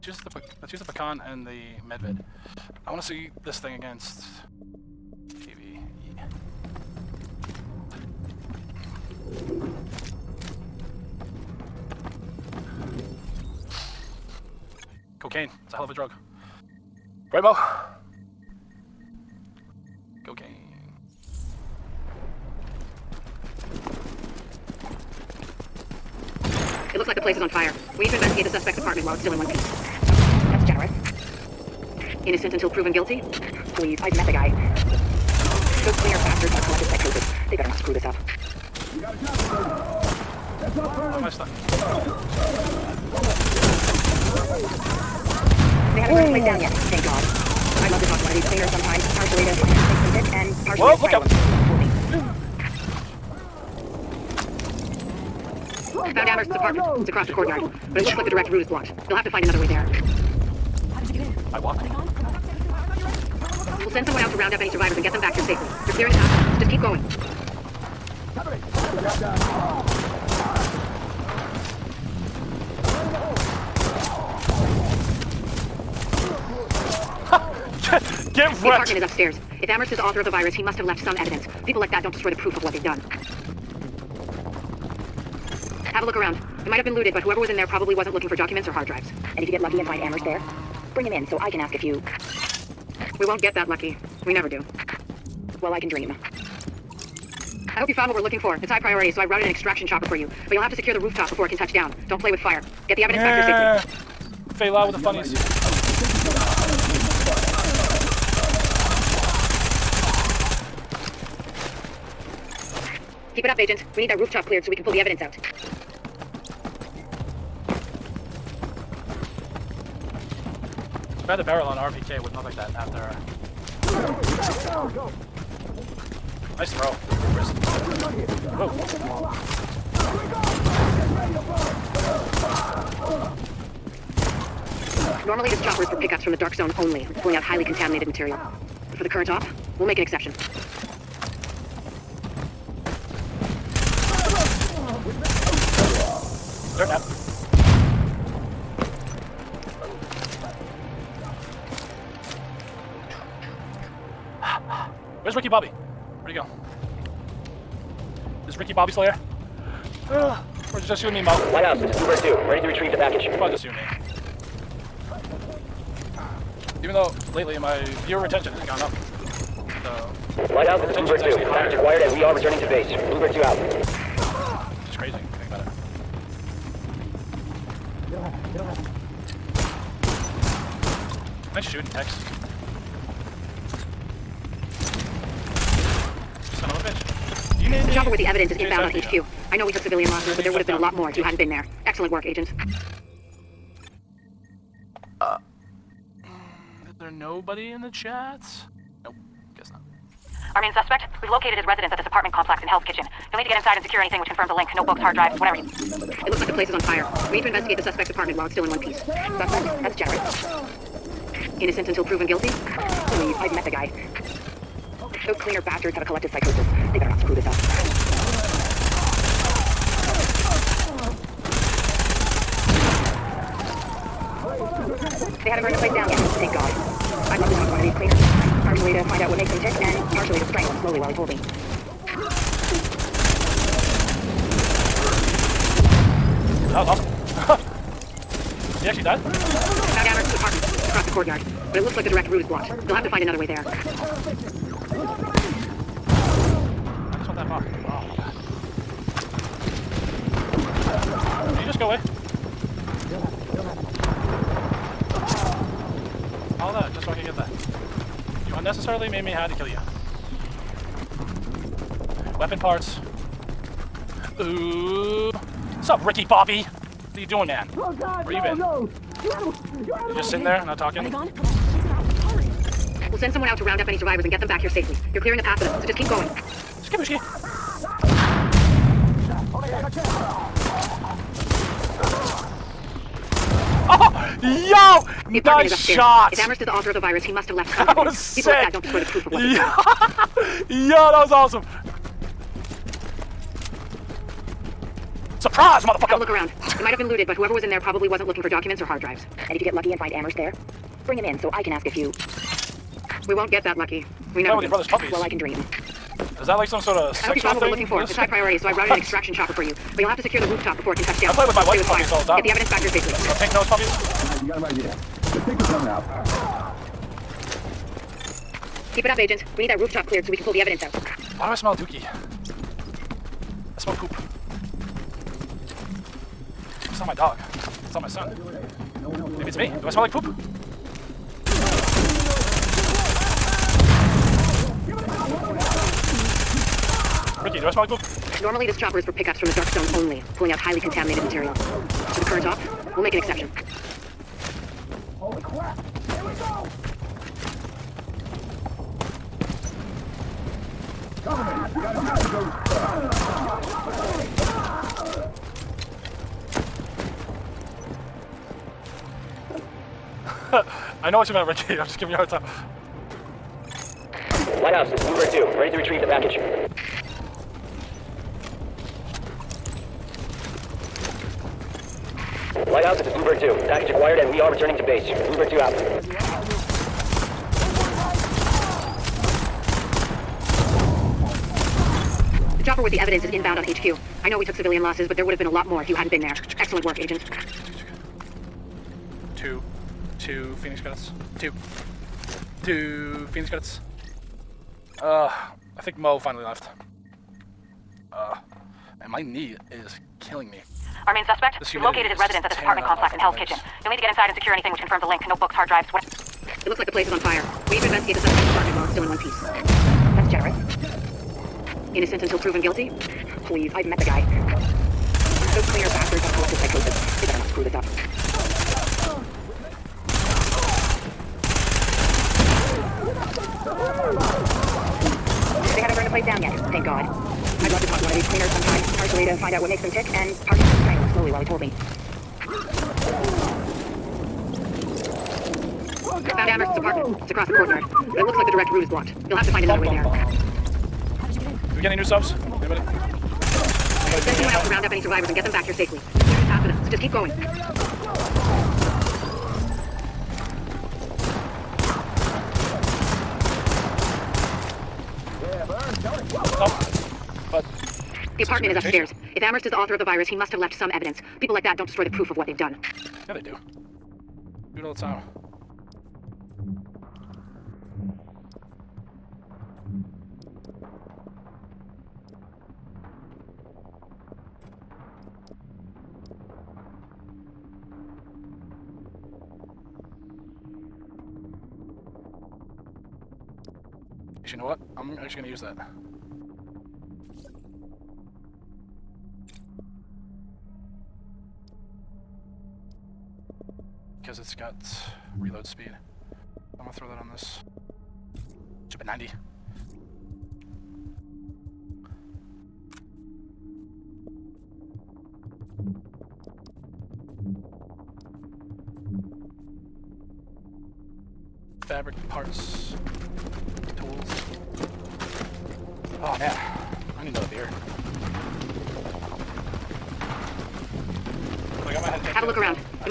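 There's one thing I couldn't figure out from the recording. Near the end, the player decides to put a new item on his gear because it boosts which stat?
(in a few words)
reload speed.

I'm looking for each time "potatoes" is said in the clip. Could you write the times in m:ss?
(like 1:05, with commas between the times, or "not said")
not said.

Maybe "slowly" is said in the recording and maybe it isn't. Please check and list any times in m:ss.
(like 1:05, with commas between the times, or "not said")
3:50, 7:11.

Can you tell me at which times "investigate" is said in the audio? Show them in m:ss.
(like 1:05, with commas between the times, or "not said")
0:28, 3:27, 6:47.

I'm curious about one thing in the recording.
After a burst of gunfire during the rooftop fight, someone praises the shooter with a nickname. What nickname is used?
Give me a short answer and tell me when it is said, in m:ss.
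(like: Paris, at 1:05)
Tex, at 3:01.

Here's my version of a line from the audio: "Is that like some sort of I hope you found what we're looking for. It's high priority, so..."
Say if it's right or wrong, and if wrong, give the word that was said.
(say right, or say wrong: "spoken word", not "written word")
right.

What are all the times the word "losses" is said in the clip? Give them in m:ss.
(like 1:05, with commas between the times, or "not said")
3:10, 6:24.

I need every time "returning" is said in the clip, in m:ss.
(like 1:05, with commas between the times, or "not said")
2:52, 6:14.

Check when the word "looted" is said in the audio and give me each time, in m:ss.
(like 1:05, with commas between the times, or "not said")
1:26, 4:57.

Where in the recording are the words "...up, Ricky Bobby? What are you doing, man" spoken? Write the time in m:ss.
4:25.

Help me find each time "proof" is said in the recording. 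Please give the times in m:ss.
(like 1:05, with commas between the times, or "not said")
1:22, 4:49, 7:42.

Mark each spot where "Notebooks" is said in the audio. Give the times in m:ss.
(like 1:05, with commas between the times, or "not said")
3:24, 6:45.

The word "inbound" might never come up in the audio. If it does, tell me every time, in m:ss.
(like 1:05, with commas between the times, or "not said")
3:08, 6:23.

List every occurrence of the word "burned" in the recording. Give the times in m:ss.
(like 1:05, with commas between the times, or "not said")
0:46, 3:45, 7:05.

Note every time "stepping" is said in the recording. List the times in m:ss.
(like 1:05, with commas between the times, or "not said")
not said.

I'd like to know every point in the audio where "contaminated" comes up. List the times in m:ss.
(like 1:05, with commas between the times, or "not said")
2:17, 5:40.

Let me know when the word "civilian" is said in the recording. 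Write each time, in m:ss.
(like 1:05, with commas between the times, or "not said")
3:09, 6:24.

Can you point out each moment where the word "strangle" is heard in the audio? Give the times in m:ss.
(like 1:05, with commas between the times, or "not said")
3:50, 7:10.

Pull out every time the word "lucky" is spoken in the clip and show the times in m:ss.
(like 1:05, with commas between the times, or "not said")
1:29, 1:33, 4:59, 5:03.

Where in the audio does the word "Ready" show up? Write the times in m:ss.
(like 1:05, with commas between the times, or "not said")
2:42, 6:05.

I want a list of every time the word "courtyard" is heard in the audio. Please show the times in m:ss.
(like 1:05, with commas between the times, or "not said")
0:57, 4:01, 7:17.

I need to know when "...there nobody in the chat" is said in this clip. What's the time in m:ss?
3:17.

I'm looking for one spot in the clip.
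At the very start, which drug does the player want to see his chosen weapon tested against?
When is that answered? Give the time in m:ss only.
0:20.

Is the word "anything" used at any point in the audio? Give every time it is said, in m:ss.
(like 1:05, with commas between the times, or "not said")
3:23, 6:44.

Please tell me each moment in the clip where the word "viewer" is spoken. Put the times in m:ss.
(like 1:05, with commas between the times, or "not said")
2:48.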